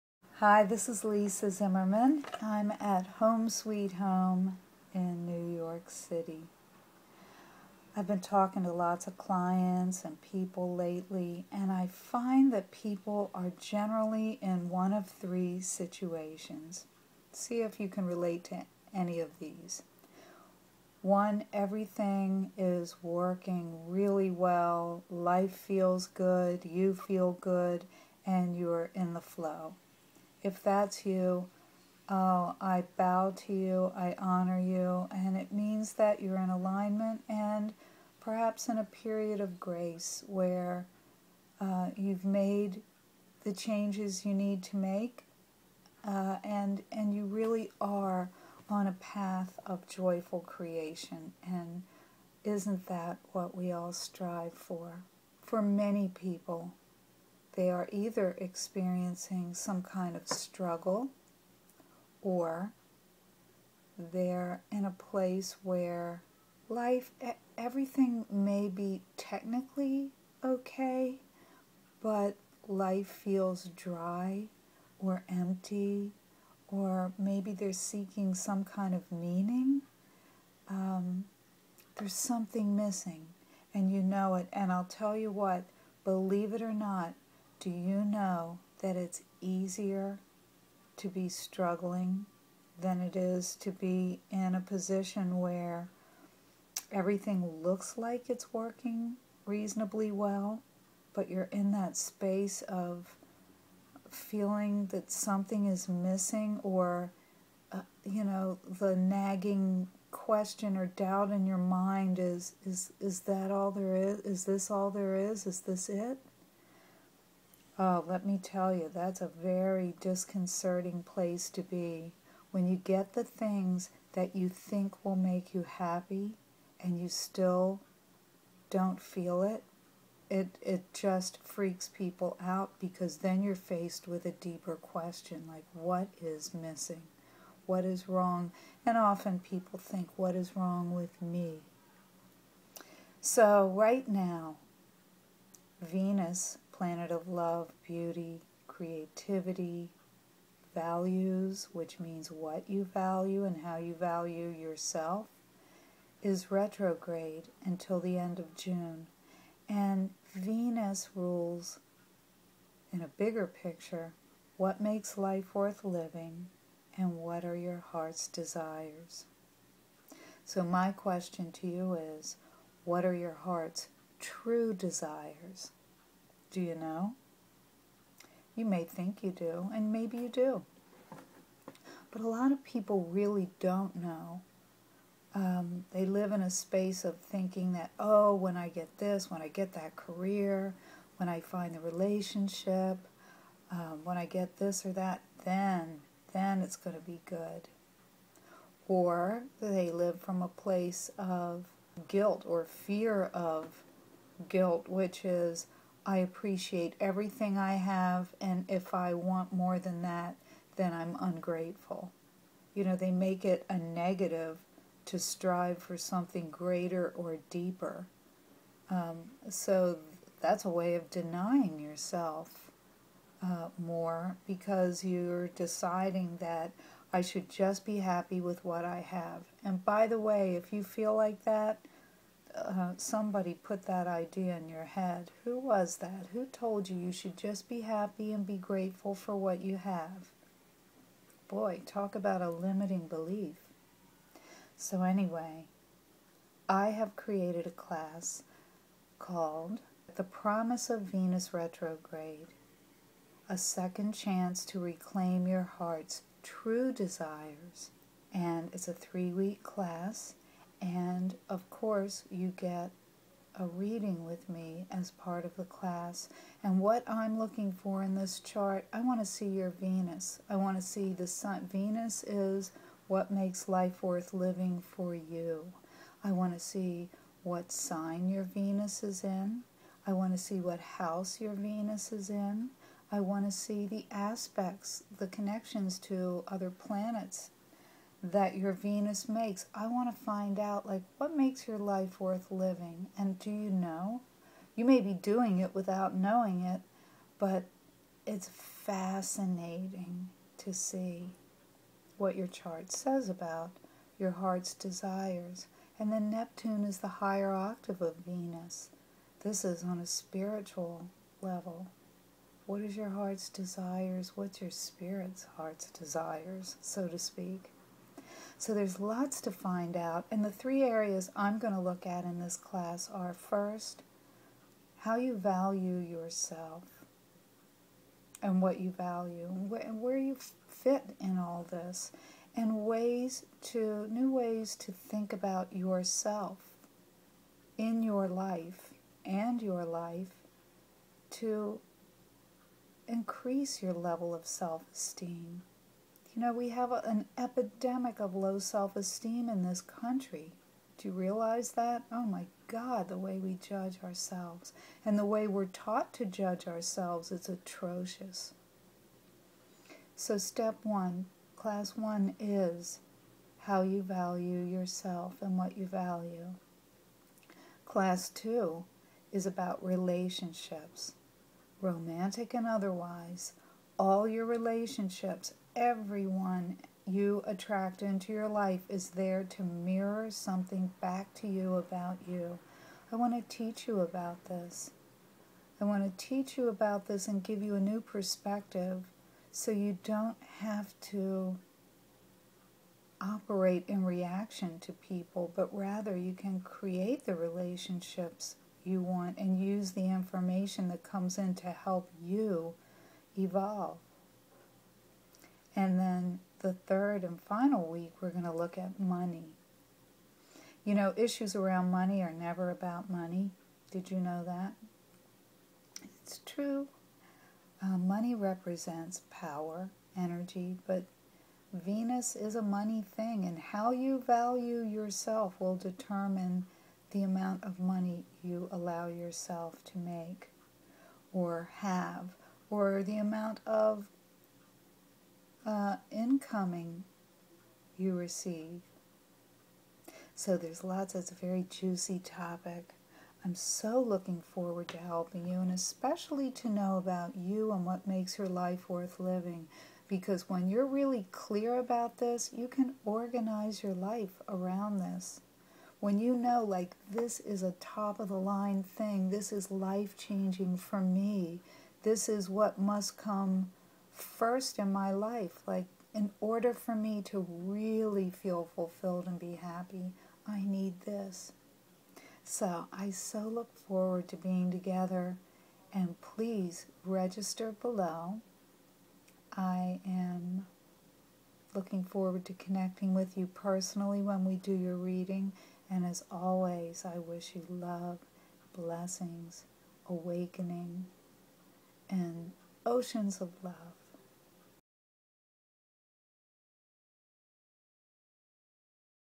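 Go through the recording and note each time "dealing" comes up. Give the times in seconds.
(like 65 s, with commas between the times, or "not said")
not said.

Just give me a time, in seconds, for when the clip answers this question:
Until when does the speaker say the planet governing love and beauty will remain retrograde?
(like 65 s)
158 s.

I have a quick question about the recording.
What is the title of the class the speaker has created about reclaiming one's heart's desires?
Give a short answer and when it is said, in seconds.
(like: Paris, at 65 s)
The Promise of Venus Retrograde, at 250 s.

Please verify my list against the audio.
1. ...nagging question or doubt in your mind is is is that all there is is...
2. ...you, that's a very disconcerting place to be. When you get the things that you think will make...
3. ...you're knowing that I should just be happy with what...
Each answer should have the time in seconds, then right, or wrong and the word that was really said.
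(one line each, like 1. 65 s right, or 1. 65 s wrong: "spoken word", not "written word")
1. 108 s right
2. 118 s right
3. 225 s wrong: "deciding", not "knowing".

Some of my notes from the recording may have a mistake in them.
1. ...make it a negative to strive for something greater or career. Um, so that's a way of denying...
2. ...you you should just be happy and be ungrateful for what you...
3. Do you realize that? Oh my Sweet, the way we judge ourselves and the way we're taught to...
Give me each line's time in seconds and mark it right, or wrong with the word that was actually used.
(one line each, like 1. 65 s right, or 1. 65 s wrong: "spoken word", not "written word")
1. 213 s wrong: "deeper", not "career"
2. 236 s wrong: "grateful", not "ungrateful"
3. 350 s wrong: "God", not "Sweet".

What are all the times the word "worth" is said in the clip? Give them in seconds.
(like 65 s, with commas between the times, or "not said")
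165 s, 274 s, 292 s, 448 s.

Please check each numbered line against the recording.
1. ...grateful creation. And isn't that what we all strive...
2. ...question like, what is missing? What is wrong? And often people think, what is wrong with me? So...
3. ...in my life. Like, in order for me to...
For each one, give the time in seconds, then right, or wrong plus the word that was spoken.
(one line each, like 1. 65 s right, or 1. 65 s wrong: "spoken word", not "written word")
1. 49 s wrong: "joyful", not "grateful"
2. 134 s right
3. 464 s right.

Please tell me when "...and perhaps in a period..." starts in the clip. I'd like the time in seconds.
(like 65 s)
37 s.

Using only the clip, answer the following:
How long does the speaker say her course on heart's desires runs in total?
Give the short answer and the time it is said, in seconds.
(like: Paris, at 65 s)
3 weeks, at 258 s.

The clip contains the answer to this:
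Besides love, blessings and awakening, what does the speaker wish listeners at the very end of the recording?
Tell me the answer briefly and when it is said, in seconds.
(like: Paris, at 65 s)
Oceans of love, at 492 s.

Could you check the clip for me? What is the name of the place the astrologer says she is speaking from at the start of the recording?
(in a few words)
Home Sweet Home.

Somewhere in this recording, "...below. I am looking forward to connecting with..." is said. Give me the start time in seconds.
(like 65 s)
477 s.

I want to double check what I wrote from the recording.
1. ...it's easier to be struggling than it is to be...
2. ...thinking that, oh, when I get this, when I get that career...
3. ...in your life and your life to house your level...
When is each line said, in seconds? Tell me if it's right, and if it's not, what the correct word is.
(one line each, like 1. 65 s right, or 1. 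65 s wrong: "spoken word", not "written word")
1. 88 s right
2. 187 s right
3. 337 s wrong: "increase", not "house".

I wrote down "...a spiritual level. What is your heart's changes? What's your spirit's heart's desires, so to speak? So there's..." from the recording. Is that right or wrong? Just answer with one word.
wrong.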